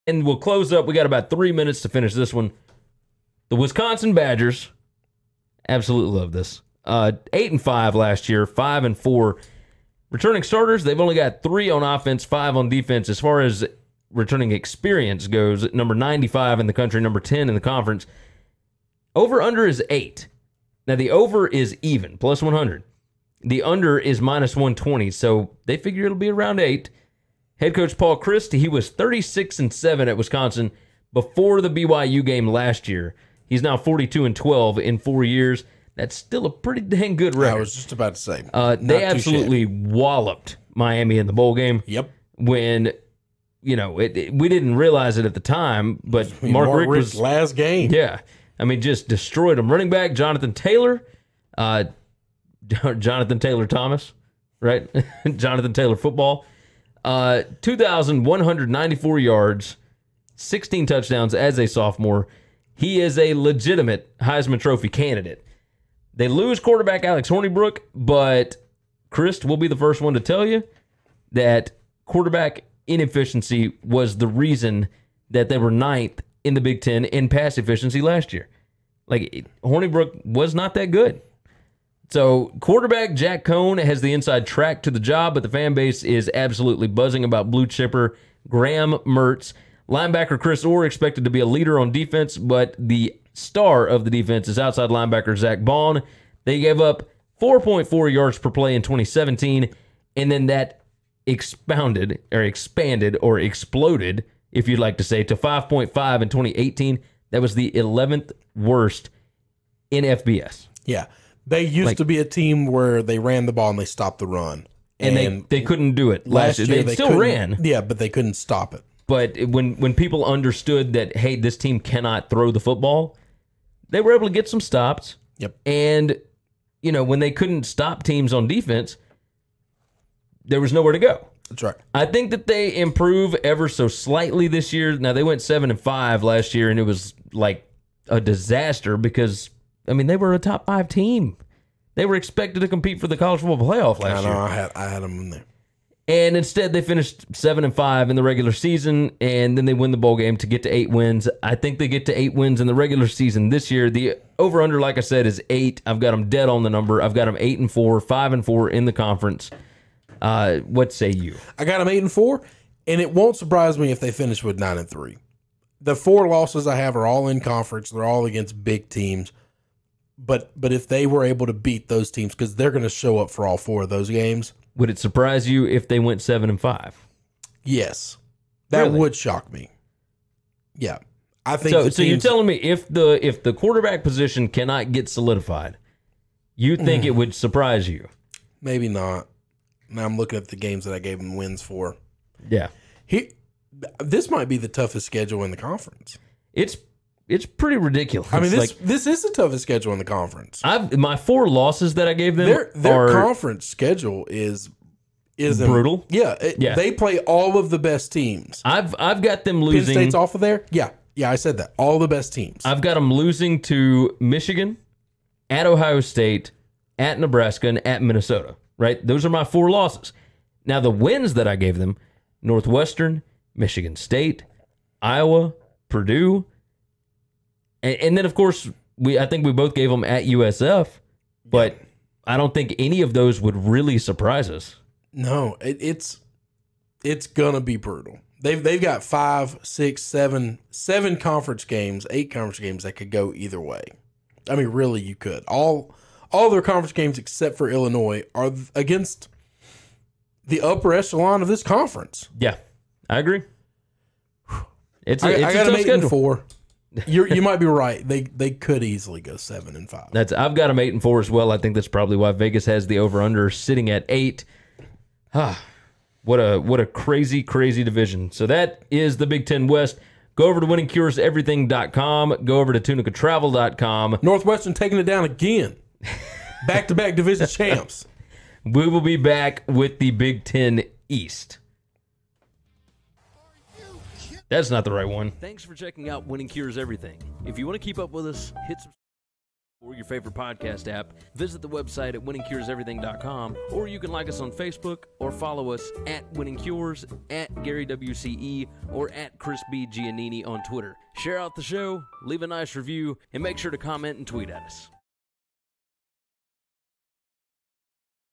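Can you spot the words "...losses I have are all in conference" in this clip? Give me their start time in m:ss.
2:46.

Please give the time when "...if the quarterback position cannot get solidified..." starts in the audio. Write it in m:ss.
3:03.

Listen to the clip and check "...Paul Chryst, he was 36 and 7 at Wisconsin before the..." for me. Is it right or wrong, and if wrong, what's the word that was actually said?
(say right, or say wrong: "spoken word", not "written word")
right.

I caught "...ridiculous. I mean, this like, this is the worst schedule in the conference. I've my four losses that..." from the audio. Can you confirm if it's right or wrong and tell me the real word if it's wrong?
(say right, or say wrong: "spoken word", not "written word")
wrong: "toughest", not "worst".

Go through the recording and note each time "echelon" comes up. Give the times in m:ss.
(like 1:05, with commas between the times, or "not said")
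4:10.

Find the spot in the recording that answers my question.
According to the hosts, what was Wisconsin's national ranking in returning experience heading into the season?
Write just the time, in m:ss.
0:15.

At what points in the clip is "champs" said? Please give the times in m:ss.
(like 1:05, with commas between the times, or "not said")
4:37.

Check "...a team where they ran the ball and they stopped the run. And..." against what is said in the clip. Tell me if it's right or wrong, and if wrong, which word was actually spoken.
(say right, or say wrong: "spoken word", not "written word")
right.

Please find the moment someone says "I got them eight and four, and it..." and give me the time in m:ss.
2:41.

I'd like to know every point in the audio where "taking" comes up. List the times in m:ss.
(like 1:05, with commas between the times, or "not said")
4:34.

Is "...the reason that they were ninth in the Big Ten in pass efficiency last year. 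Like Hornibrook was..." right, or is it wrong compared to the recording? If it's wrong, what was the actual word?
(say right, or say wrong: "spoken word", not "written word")
right.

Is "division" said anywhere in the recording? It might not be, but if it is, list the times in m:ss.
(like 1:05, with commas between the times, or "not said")
4:27, 4:37.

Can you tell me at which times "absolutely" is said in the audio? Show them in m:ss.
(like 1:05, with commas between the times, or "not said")
0:05, 0:39, 1:26.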